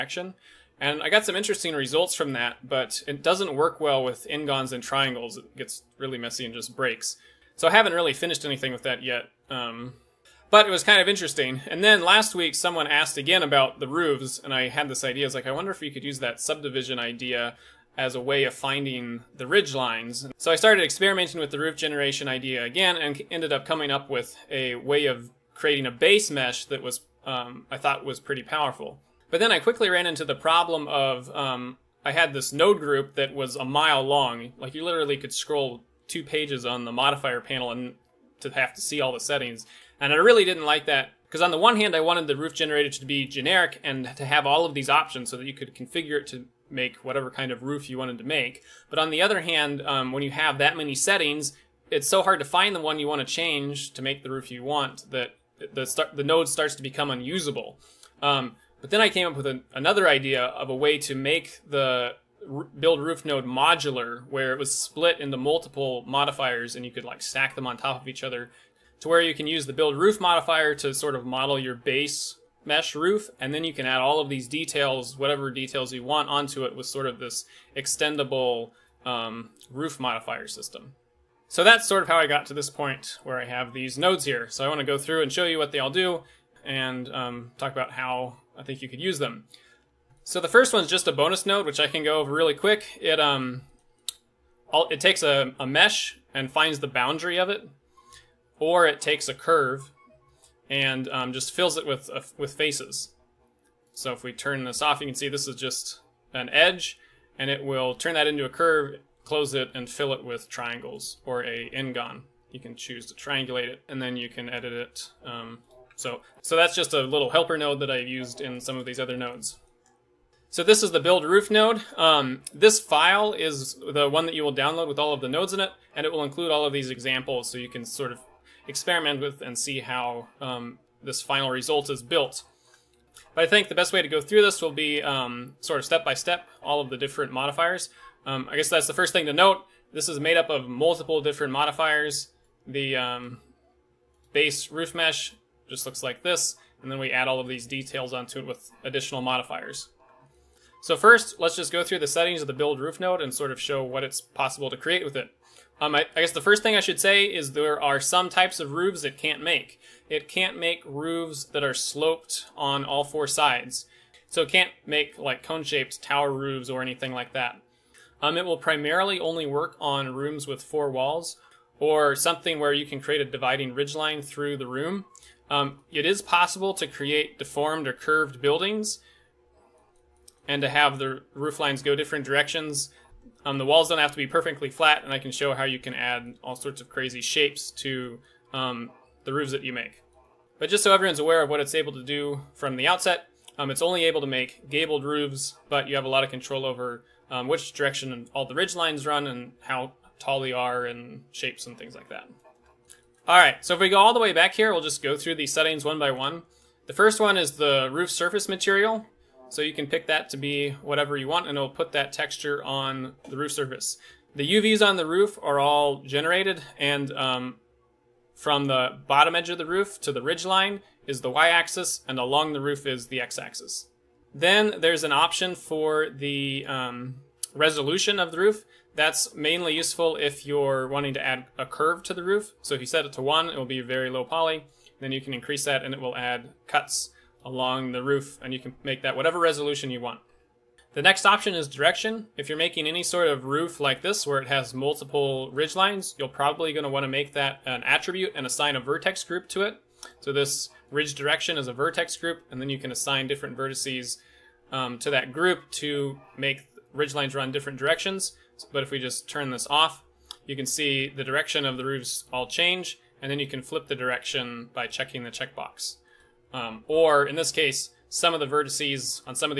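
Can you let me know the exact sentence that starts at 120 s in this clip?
So this is the build roof node.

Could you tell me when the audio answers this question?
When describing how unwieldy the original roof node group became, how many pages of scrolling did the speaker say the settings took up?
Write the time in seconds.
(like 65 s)
36 s.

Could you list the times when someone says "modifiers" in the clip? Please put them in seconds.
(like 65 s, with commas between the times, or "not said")
36 s, 66 s, 70 s, 79 s, 137 s, 141 s, 149 s.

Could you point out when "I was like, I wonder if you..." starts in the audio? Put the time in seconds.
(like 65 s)
15 s.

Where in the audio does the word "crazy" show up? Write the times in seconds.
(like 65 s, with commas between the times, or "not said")
186 s.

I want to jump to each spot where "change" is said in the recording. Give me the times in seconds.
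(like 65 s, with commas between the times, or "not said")
53 s, 262 s.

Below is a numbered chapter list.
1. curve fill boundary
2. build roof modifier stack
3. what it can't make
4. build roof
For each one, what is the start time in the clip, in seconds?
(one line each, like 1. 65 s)
1. 89 s
2. 119 s
3. 155 s
4. 202 s.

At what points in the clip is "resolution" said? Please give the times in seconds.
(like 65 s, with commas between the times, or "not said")
227 s, 239 s.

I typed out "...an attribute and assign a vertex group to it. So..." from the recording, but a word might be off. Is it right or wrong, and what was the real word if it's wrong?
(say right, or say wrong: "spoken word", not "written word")
right.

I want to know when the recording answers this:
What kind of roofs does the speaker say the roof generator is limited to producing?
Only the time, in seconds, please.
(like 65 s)
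194 s.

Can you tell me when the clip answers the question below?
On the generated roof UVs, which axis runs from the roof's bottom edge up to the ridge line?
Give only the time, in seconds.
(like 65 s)
221 s.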